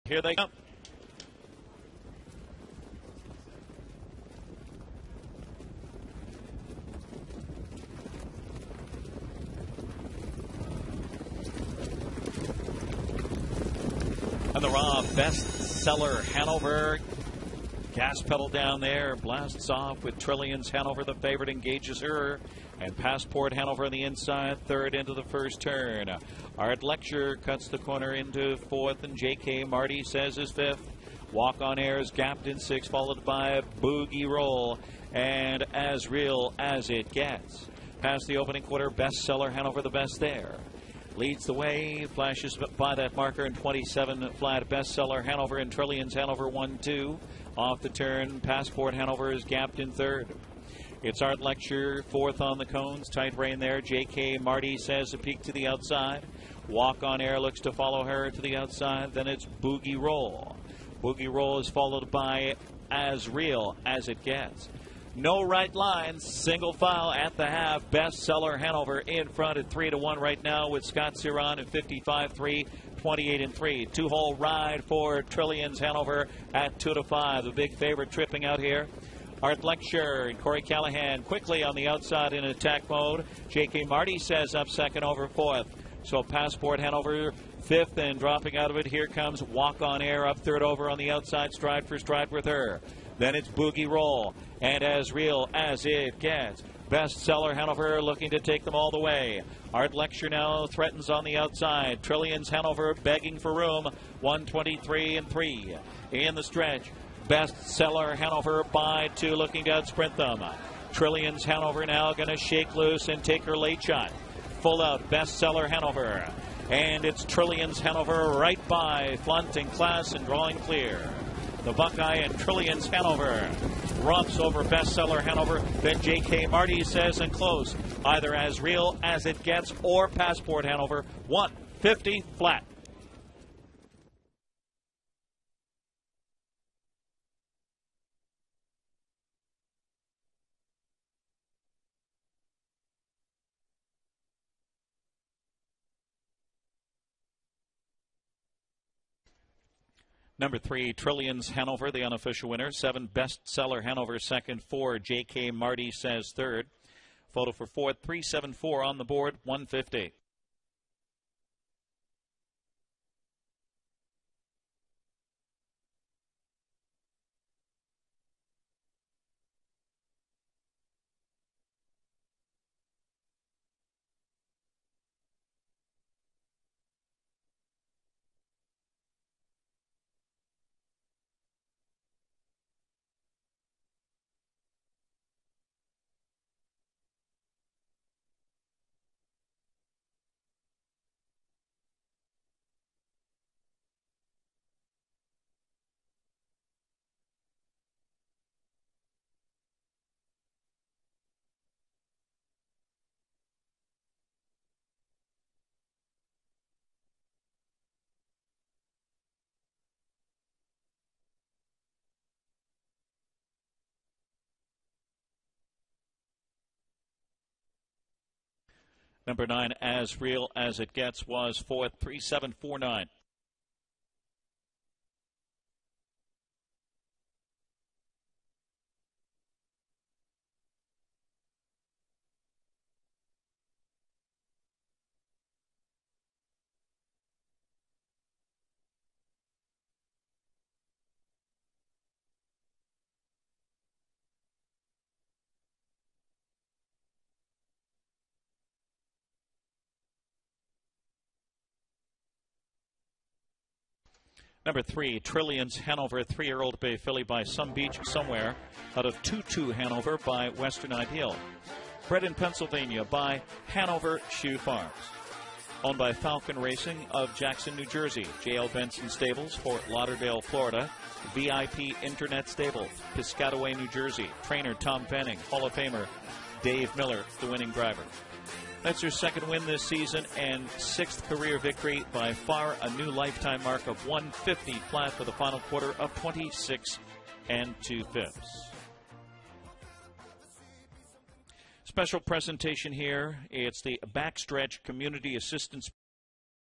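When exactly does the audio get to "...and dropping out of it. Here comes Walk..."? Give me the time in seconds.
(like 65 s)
87 s.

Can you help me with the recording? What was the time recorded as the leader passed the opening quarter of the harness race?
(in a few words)
27 flat.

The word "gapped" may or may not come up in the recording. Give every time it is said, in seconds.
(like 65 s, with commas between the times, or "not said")
32 s, 49 s.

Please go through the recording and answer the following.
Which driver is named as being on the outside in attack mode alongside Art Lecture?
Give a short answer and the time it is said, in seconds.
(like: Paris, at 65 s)
Corey Callahan, at 80 s.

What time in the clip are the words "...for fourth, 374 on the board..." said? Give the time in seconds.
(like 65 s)
157 s.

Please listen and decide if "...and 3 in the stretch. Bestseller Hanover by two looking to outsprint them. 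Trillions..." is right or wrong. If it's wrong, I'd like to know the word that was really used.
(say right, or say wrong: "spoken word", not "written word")
right.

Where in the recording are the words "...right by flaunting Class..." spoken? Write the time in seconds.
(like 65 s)
118 s.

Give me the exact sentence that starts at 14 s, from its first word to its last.
And the Raw best seller Hanover Gas pedal down there, blasts off with Trillions.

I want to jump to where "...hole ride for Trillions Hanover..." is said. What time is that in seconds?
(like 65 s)
74 s.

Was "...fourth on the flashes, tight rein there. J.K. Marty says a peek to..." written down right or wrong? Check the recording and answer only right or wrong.
wrong.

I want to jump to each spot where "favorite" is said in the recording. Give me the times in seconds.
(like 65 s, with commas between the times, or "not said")
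21 s, 77 s.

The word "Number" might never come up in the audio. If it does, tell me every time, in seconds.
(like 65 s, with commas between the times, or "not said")
150 s, 219 s, 254 s.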